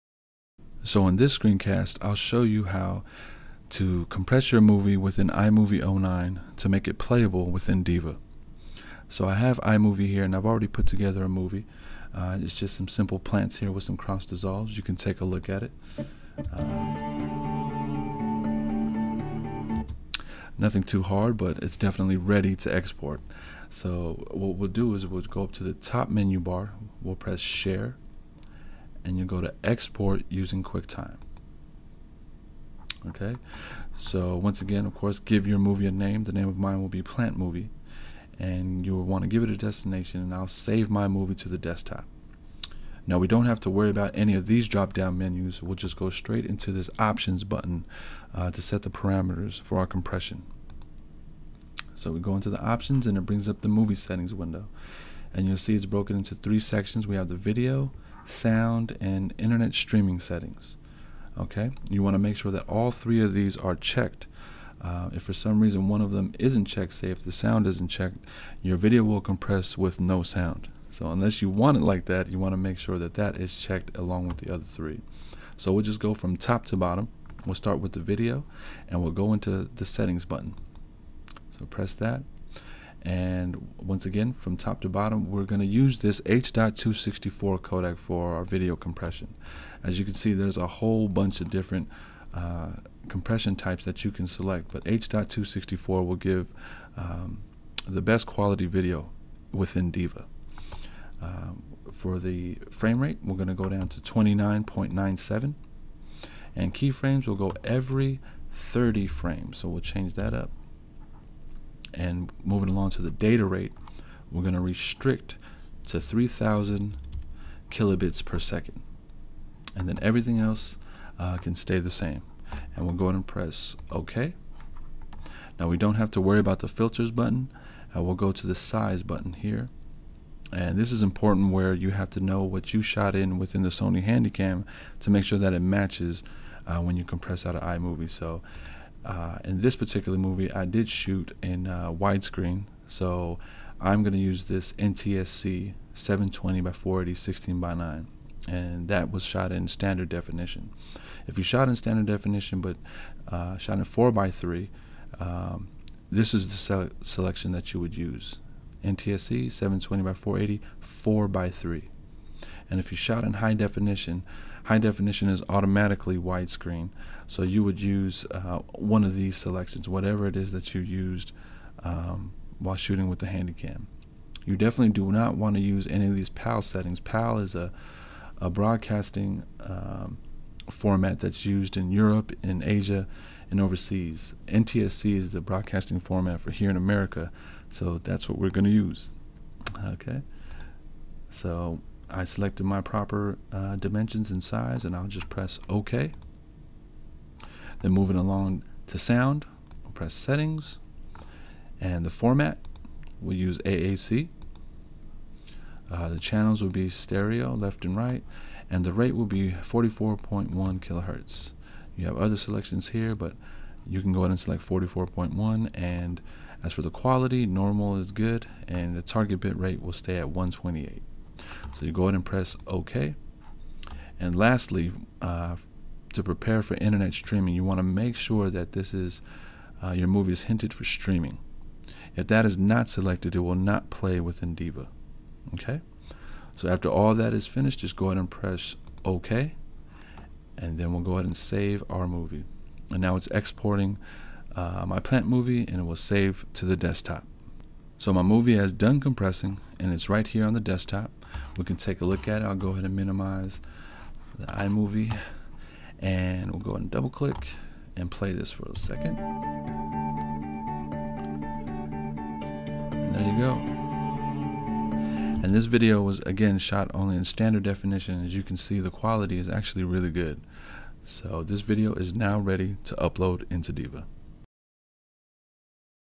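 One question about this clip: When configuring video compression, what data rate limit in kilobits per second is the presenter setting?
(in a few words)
3,000.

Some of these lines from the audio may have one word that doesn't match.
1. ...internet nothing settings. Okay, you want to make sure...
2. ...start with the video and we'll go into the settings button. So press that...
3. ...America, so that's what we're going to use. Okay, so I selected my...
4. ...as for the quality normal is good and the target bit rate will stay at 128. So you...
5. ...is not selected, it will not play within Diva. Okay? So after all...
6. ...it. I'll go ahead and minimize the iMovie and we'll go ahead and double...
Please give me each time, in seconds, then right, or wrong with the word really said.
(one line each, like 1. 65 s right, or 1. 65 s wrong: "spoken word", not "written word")
1. 59 s wrong: "streaming", not "nothing"
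2. 77 s right
3. 186 s right
4. 216 s right
5. 232 s right
6. 252 s right.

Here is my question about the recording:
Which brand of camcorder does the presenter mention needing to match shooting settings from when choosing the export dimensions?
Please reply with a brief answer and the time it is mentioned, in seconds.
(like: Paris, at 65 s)
Sony Handycam, at 133 s.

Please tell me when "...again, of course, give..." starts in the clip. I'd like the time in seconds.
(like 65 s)
34 s.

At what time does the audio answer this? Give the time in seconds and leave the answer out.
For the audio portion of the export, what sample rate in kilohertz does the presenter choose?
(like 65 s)
209 s.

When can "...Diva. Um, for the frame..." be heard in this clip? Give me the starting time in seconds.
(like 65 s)
99 s.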